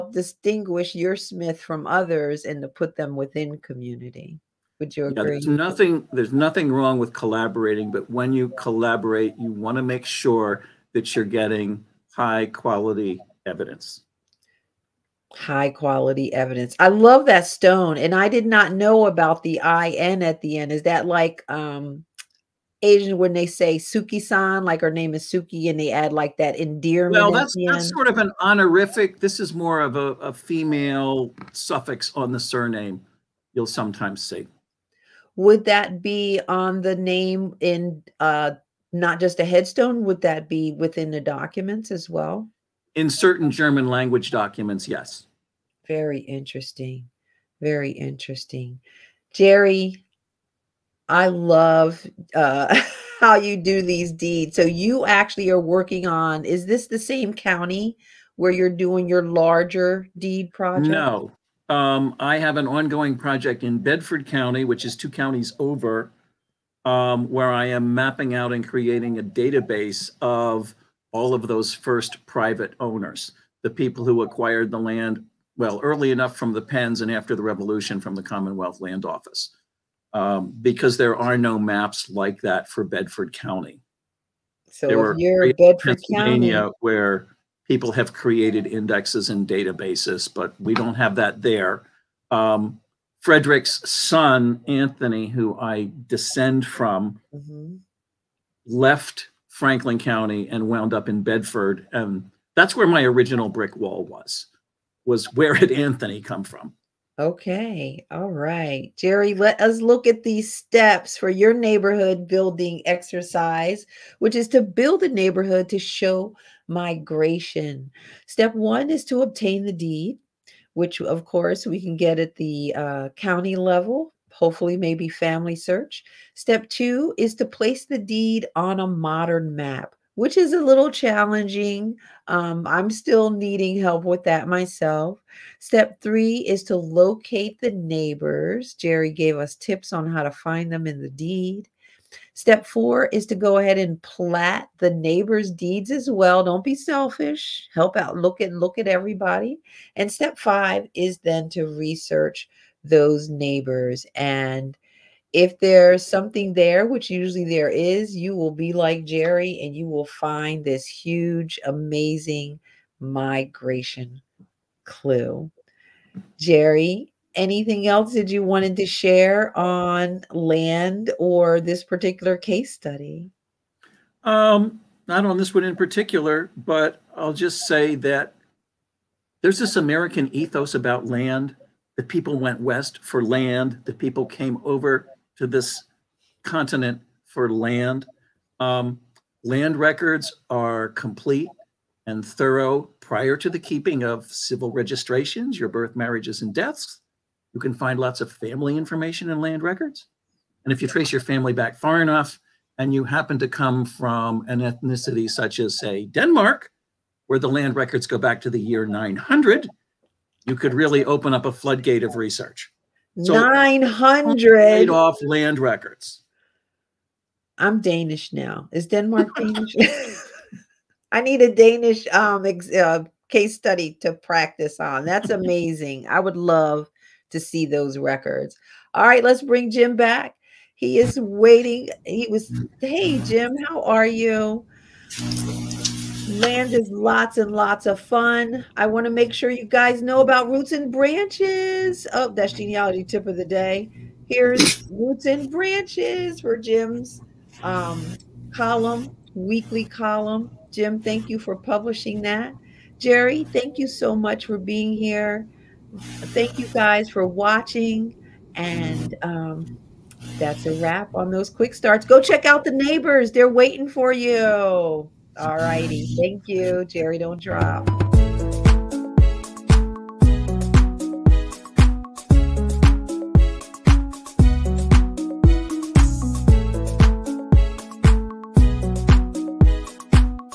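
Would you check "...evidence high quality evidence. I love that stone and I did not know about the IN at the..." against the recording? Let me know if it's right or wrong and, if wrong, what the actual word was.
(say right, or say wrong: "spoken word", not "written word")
right.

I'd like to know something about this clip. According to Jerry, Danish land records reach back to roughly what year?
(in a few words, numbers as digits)
900.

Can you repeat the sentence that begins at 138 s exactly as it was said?
Jerry gave us tips on how to find them in the deed.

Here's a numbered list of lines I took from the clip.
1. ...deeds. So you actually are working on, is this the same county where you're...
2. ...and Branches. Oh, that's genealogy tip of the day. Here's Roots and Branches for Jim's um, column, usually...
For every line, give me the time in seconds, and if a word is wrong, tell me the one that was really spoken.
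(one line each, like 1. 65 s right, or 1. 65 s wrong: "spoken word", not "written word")
1. 54 s right
2. 240 s wrong: "weekly", not "usually".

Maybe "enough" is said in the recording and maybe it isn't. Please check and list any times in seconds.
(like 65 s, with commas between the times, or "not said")
76 s, 202 s.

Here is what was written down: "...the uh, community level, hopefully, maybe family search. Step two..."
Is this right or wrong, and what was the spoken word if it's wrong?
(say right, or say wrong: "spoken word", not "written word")
wrong: "county", not "community".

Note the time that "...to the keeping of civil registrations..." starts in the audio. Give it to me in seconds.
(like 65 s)
193 s.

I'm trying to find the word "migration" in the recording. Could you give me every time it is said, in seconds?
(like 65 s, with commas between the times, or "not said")
116 s, 162 s.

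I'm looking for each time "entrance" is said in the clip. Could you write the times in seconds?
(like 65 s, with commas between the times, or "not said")
not said.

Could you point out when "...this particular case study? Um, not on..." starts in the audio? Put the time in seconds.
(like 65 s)
171 s.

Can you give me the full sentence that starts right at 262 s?
Go check out the neighbors, they're waiting for you.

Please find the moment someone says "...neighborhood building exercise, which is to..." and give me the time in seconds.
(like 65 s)
111 s.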